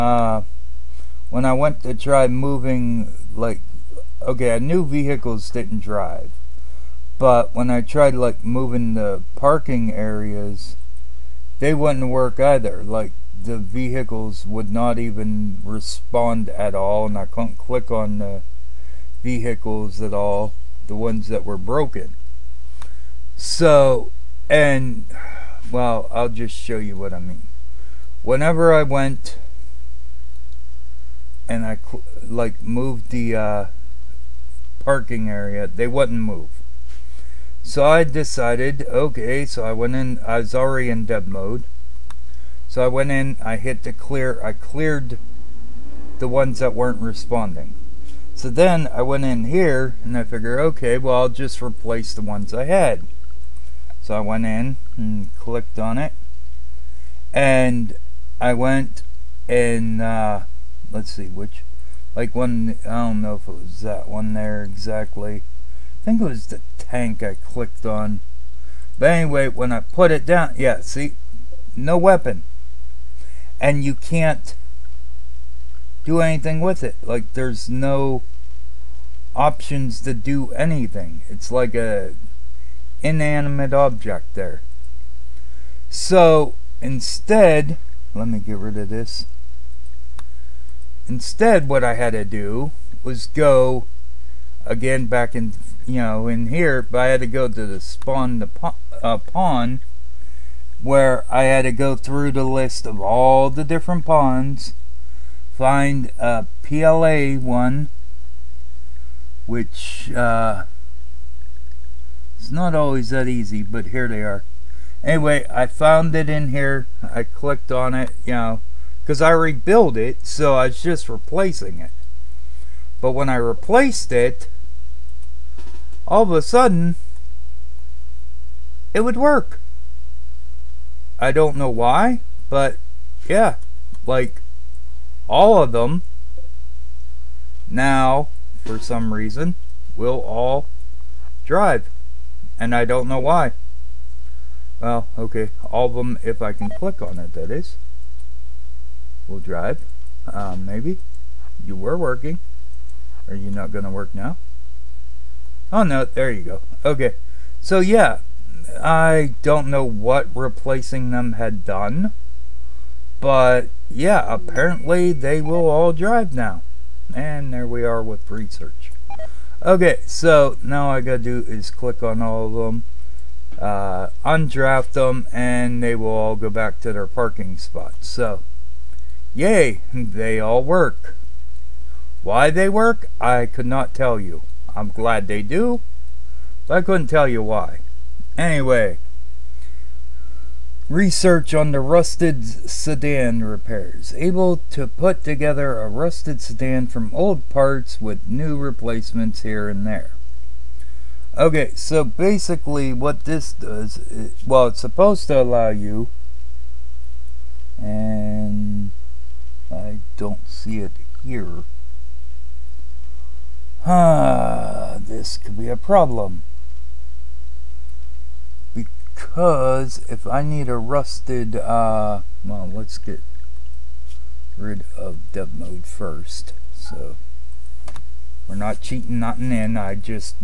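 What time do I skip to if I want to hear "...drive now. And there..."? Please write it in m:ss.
2:45.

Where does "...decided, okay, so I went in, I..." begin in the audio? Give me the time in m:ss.
0:38.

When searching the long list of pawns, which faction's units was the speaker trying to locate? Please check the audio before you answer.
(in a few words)
PLA.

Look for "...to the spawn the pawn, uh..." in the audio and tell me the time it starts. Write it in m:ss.
1:37.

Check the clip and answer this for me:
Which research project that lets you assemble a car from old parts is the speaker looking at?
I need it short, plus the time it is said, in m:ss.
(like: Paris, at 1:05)
rusted sedan repairs, at 3:11.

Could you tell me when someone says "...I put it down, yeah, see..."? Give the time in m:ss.
1:09.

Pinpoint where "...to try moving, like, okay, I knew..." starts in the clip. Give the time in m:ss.
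0:01.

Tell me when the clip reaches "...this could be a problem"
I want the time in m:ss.
3:34.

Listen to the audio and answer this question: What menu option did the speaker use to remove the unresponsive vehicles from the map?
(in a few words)
clear.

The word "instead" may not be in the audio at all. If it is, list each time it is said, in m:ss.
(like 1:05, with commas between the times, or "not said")
1:26, 1:31.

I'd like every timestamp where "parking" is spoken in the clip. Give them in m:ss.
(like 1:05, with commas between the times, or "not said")
0:09, 0:34, 2:57.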